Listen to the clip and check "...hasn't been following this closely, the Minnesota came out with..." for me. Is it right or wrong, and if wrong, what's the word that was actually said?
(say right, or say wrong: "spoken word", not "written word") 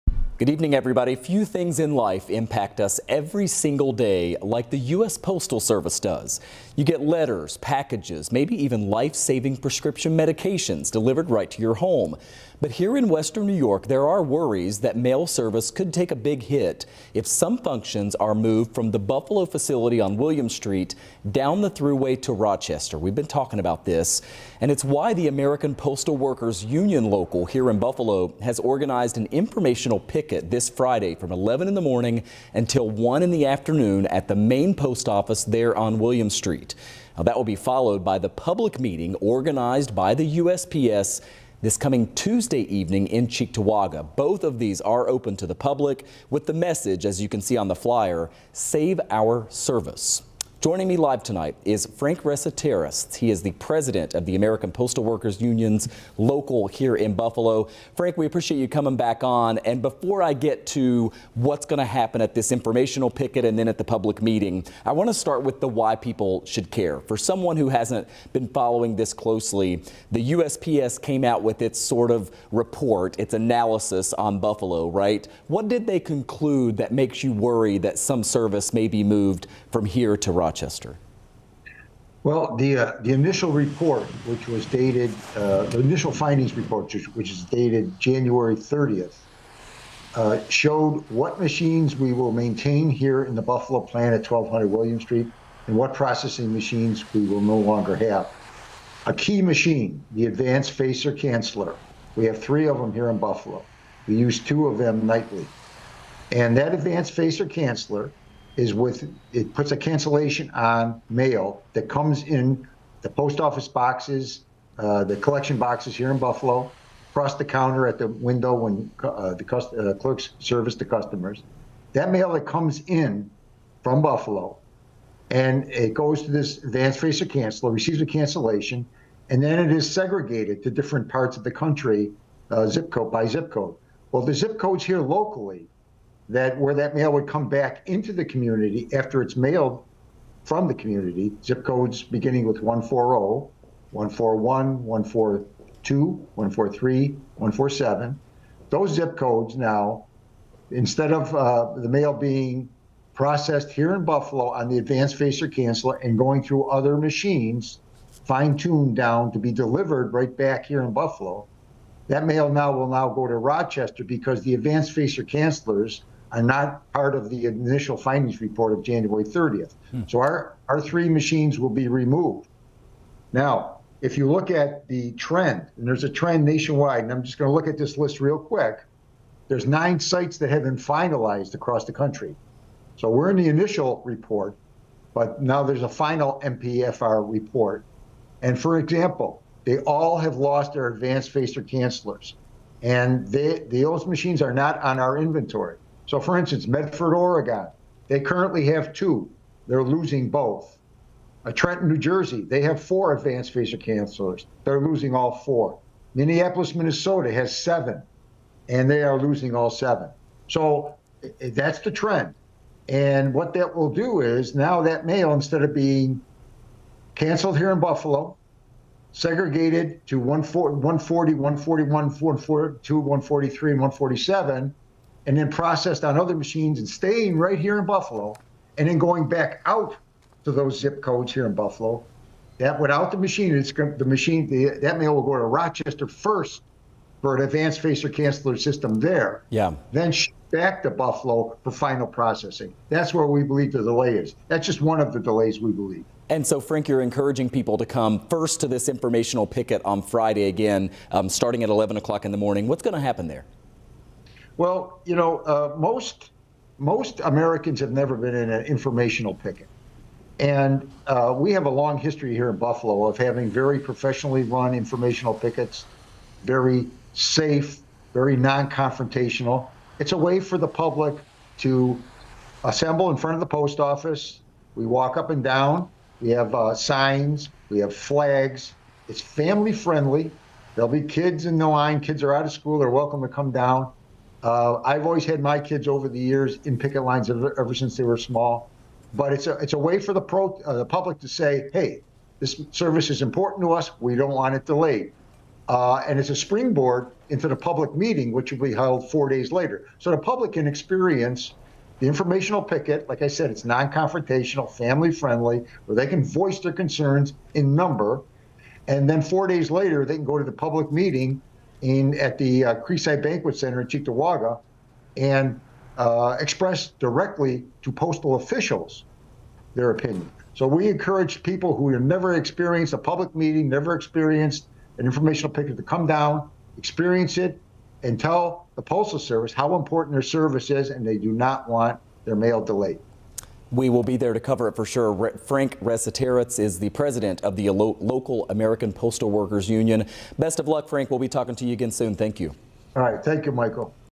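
wrong: "USPS", not "Minnesota".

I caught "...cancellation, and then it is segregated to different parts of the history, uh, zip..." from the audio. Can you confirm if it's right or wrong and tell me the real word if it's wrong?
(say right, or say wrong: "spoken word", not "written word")
wrong: "country", not "history".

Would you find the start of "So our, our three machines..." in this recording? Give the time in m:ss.
2:50.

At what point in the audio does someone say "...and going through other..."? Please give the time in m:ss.
2:36.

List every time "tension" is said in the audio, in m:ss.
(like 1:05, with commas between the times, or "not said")
not said.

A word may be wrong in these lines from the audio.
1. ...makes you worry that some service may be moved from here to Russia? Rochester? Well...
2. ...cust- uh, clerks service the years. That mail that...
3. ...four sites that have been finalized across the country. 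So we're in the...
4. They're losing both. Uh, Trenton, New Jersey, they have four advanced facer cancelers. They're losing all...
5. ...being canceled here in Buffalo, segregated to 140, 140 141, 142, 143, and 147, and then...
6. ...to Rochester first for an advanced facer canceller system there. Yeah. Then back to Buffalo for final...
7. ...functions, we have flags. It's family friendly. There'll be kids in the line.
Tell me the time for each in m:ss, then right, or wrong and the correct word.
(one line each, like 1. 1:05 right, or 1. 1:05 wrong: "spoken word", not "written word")
1. 1:16 right
2. 1:59 wrong: "customers", not "years"
3. 2:59 wrong: "nine", not "four"
4. 3:19 right
5. 3:35 right
6. 3:55 right
7. 4:36 wrong: "signs", not "functions".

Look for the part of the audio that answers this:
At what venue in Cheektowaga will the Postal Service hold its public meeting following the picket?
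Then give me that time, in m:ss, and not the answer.
5:12.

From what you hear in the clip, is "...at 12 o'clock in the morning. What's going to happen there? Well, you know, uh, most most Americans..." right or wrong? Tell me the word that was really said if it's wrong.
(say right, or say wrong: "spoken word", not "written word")
wrong: "11", not "12".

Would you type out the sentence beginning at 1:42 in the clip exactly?
We have three of them here in Buffalo.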